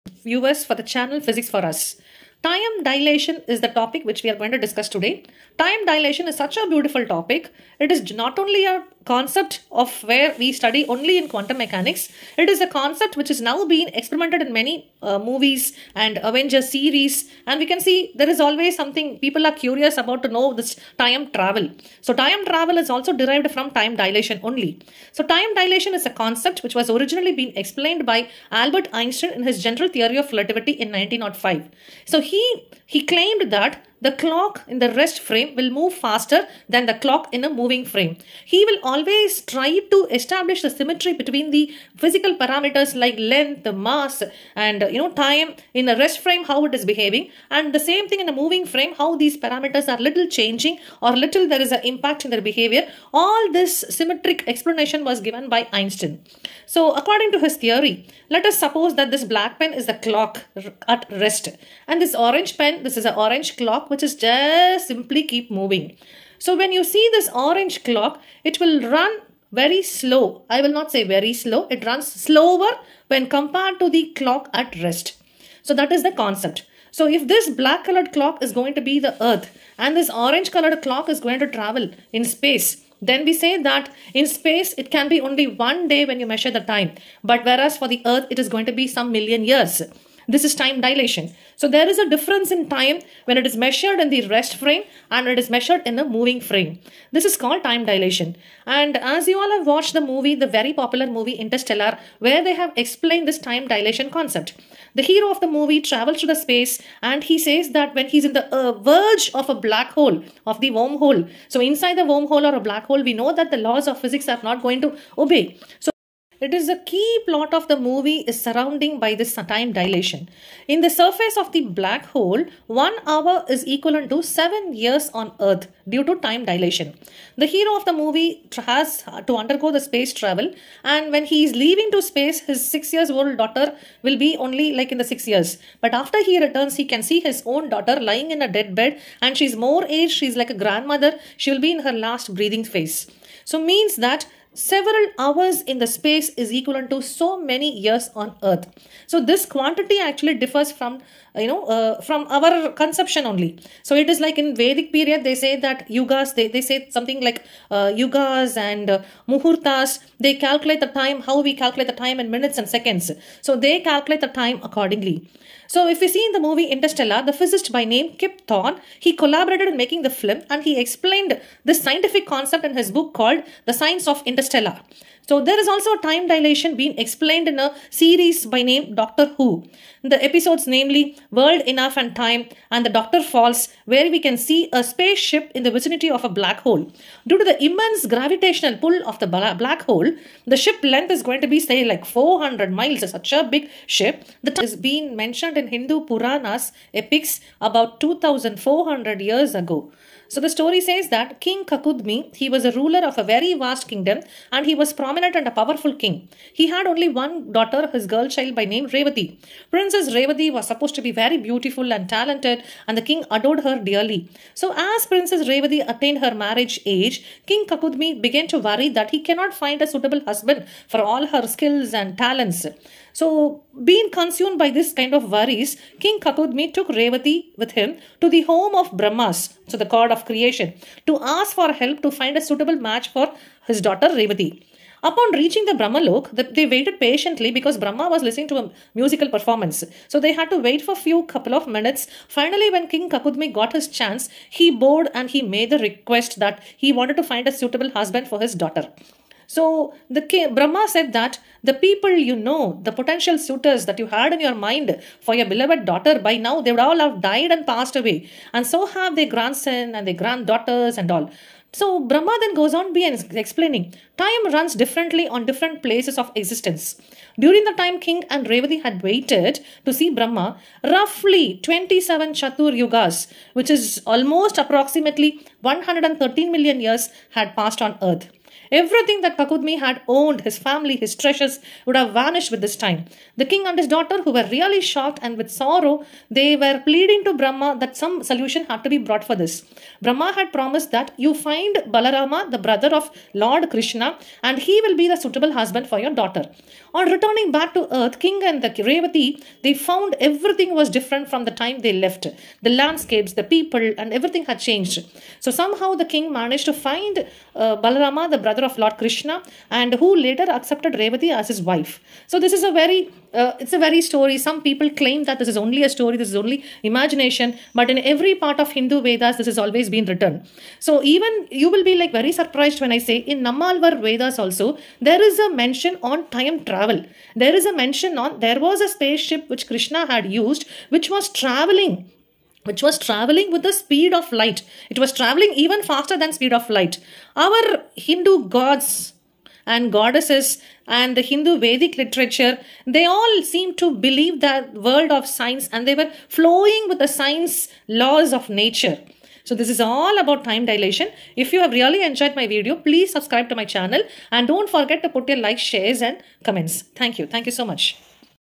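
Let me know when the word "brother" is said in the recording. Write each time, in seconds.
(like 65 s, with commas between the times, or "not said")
292 s, 308 s.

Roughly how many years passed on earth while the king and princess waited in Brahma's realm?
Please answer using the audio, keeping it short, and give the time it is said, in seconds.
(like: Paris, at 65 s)
113 million years, at 275 s.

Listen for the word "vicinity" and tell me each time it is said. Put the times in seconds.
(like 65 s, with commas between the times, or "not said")
185 s.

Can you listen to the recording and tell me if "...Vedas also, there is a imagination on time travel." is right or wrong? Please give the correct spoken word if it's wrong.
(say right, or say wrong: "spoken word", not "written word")
wrong: "mention", not "imagination".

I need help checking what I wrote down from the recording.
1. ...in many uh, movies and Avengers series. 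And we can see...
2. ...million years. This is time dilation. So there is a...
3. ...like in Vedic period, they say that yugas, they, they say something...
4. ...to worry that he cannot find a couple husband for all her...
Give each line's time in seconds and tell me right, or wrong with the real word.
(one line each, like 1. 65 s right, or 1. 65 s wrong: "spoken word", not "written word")
1. 14 s right
2. 89 s right
3. 154 s right
4. 218 s wrong: "suitable", not "couple".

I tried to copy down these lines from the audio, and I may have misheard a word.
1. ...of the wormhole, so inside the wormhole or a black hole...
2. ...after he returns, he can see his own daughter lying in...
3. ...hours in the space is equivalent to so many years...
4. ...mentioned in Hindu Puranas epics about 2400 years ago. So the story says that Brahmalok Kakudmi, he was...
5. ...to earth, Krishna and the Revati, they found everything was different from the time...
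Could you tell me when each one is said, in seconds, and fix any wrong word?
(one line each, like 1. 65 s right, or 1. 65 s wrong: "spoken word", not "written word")
1. 110 s right
2. 135 s right
3. 145 s right
4. 195 s wrong: "King", not "Brahmalok"
5. 297 s wrong: "King", not "Krishna".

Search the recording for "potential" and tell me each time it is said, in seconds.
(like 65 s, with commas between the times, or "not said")
252 s.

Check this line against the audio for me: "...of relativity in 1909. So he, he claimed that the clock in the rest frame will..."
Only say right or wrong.
wrong.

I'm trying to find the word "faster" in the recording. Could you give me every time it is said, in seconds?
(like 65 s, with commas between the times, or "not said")
35 s, 335 s.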